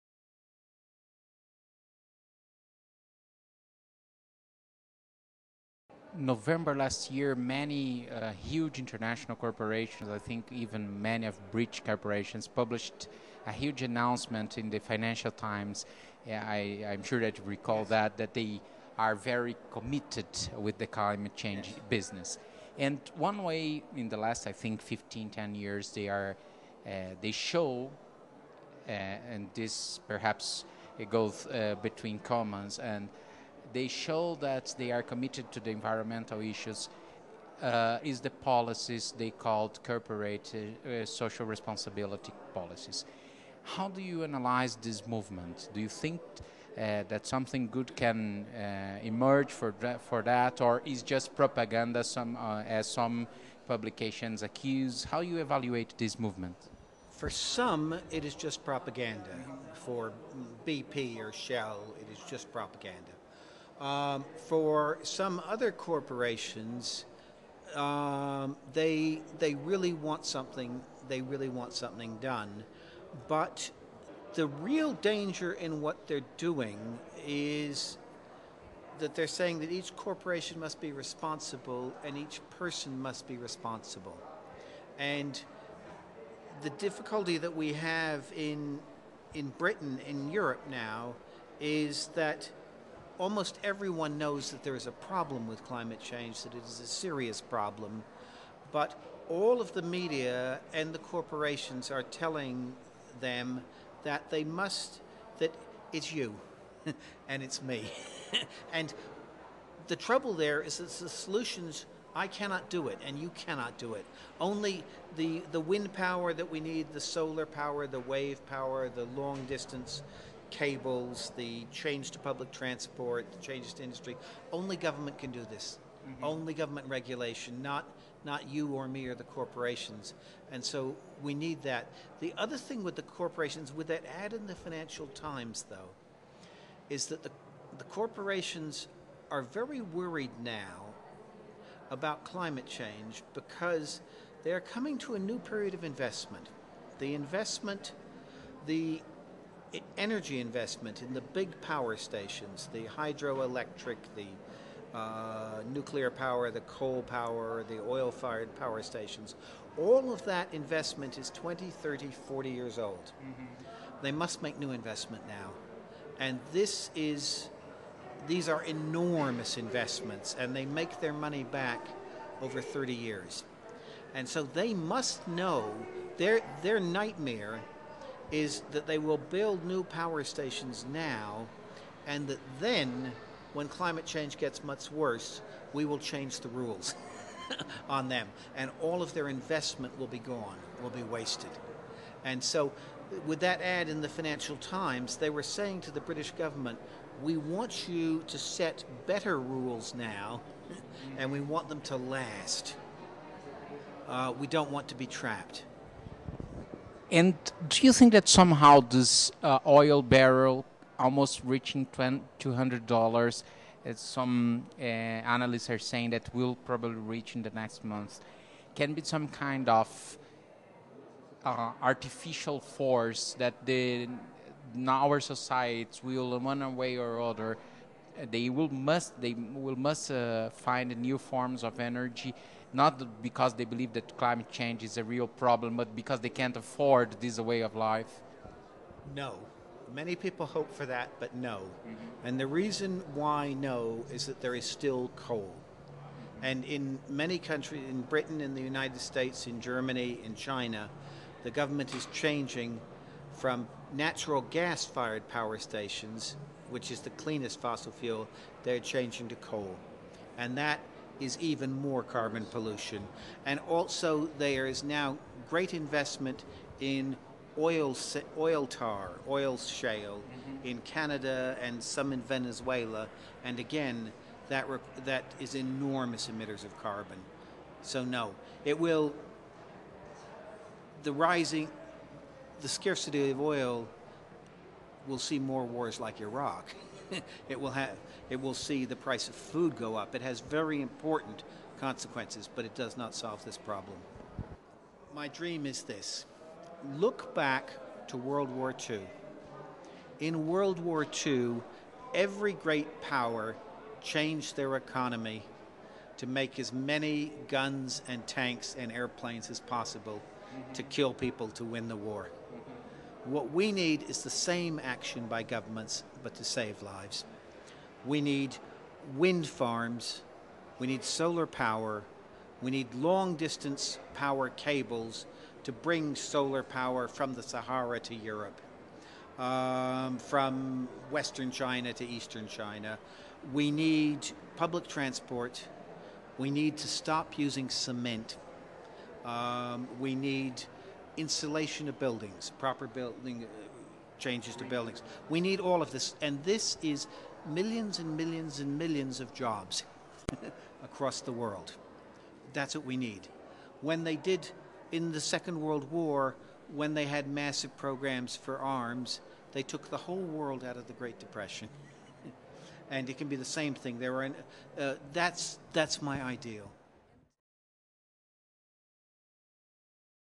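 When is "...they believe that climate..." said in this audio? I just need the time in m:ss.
3:53.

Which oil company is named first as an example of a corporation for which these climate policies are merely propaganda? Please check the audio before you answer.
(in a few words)
BP.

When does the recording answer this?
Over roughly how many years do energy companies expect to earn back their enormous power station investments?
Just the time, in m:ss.
2:52.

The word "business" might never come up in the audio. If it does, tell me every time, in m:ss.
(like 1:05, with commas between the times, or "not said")
0:21.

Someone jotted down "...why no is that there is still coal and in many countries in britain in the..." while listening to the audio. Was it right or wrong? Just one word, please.
right.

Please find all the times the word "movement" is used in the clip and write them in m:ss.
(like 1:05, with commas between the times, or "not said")
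0:45, 0:56.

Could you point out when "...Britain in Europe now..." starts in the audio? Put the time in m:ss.
1:29.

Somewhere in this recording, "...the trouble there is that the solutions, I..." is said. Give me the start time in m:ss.
1:49.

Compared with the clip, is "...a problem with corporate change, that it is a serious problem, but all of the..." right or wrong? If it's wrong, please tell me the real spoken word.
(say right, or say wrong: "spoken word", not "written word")
wrong: "climate", not "corporate".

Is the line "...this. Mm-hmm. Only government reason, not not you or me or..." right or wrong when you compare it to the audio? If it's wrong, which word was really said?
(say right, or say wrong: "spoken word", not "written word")
wrong: "regulation", not "reason".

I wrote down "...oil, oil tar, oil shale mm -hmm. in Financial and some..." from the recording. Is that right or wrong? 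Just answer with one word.
wrong.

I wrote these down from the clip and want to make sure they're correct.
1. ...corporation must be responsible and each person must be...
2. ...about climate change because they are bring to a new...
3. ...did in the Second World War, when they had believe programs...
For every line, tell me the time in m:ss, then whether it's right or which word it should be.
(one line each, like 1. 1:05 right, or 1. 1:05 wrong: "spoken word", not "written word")
1. 1:19 right
2. 2:21 wrong: "coming", not "bring"
3. 5:54 wrong: "massive", not "believe".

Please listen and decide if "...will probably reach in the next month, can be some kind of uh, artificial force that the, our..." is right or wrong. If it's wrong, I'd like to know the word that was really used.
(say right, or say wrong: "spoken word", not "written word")
right.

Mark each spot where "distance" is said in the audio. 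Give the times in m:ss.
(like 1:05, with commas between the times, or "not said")
1:59, 5:23.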